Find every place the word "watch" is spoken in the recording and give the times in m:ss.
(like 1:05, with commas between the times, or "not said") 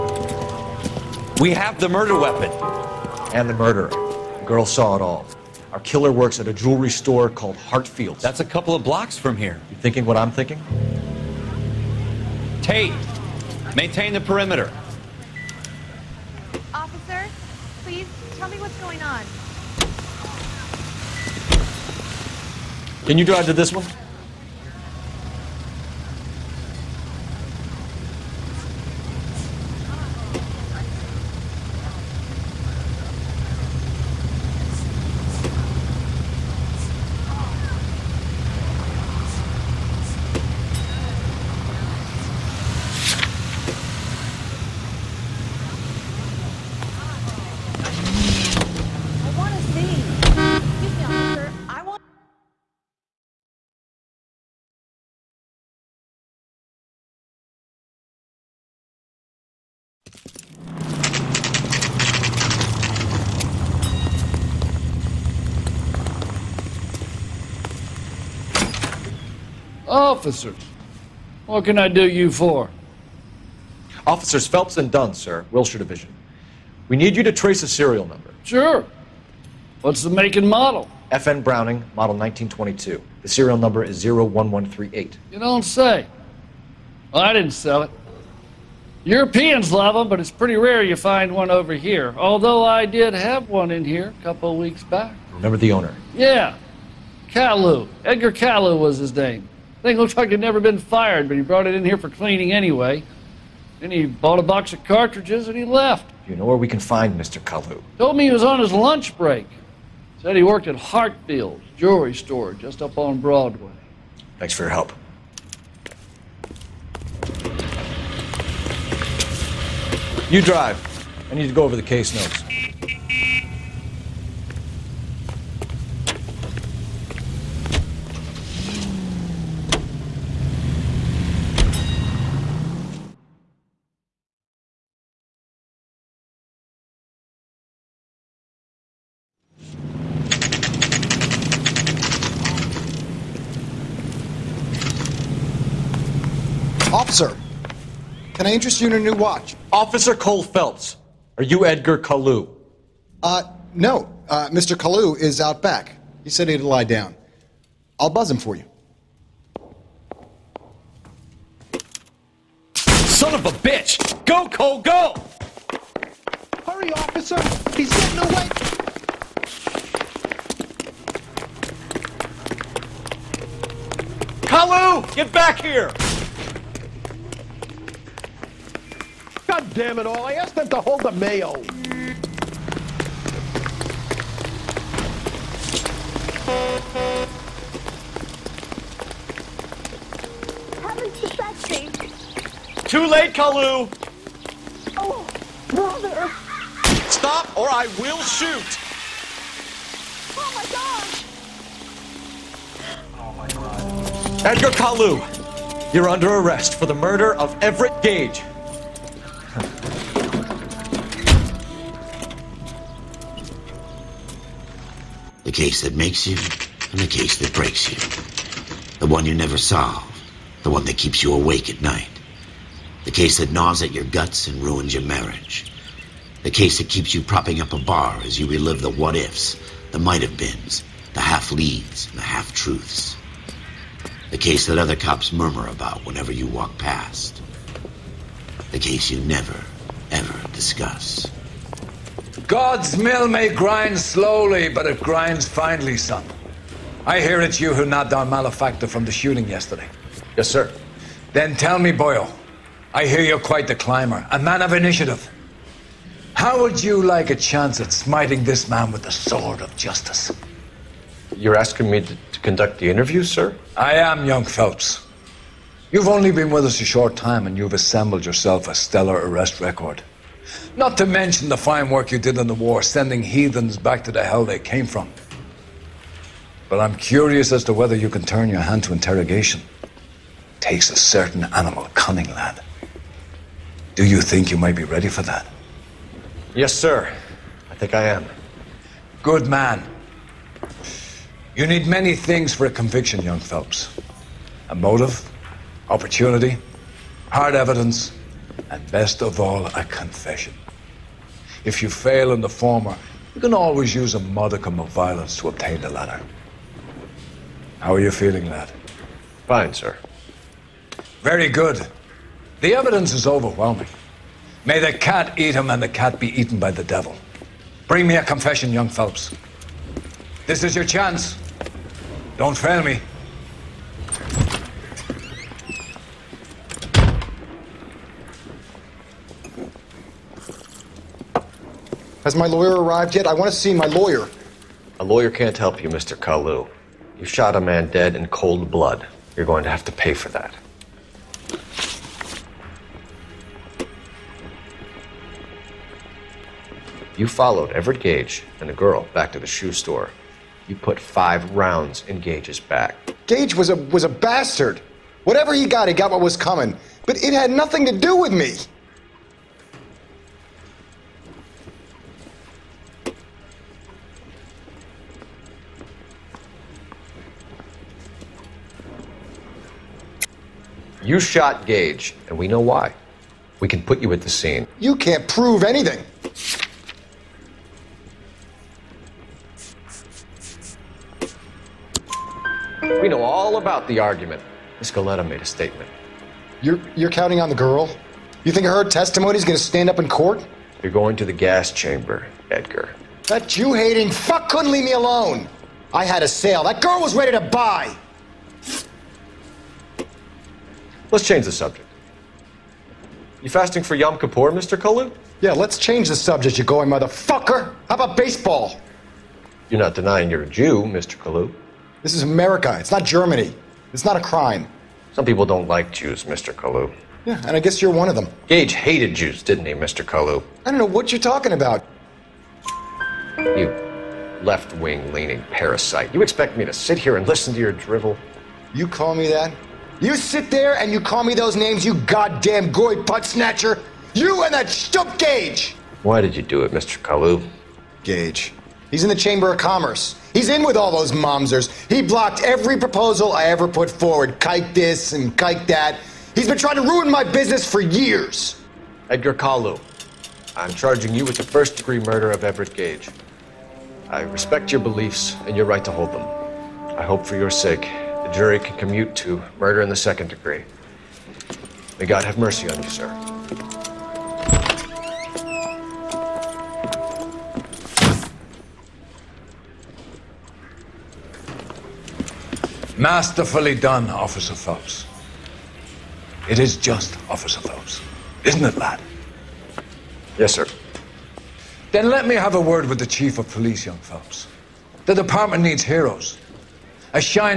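2:29.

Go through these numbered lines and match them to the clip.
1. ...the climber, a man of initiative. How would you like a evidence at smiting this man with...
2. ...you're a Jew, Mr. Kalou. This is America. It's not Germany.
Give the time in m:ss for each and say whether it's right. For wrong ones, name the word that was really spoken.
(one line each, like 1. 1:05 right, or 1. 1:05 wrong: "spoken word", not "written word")
1. 4:13 wrong: "chance", not "evidence"
2. 6:50 right.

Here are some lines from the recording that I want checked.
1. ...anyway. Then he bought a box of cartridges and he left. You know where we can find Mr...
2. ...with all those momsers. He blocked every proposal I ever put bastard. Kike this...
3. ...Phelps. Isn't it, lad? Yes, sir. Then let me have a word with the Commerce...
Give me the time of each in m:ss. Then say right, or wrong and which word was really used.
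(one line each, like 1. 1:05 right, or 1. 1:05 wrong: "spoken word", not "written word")
1. 1:42 right
2. 7:20 wrong: "forward", not "bastard"
3. 7:57 wrong: "Chief", not "Commerce".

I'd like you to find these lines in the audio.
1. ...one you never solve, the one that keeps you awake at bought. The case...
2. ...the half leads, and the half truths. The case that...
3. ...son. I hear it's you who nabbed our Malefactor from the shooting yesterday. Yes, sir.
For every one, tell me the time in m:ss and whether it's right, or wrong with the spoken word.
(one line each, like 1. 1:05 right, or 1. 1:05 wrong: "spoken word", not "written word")
1. 3:39 wrong: "night", not "bought"
2. 3:51 right
3. 4:05 right.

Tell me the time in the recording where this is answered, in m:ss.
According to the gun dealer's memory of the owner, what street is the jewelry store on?
1:53.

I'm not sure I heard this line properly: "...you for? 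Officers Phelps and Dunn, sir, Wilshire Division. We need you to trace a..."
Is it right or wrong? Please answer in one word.
right.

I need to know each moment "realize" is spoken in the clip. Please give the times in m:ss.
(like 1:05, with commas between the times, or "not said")
not said.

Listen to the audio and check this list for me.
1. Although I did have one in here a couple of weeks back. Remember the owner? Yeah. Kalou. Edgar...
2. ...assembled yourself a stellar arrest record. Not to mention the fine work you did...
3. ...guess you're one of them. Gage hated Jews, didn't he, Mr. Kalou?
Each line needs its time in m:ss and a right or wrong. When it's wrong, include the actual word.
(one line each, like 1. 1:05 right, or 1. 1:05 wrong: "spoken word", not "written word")
1. 1:32 right
2. 4:27 right
3. 6:57 right.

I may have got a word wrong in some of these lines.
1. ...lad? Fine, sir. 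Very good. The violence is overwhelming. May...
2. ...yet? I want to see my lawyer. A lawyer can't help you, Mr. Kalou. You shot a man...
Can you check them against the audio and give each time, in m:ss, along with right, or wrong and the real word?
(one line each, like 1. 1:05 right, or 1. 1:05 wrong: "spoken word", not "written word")
1. 5:08 wrong: "evidence", not "violence"
2. 5:33 right.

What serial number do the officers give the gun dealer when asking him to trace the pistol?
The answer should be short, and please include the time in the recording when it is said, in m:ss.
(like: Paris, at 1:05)
01138, at 1:24.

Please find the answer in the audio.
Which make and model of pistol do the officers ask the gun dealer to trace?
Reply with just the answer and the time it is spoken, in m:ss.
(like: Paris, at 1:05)
FN Browning 1922, at 1:21.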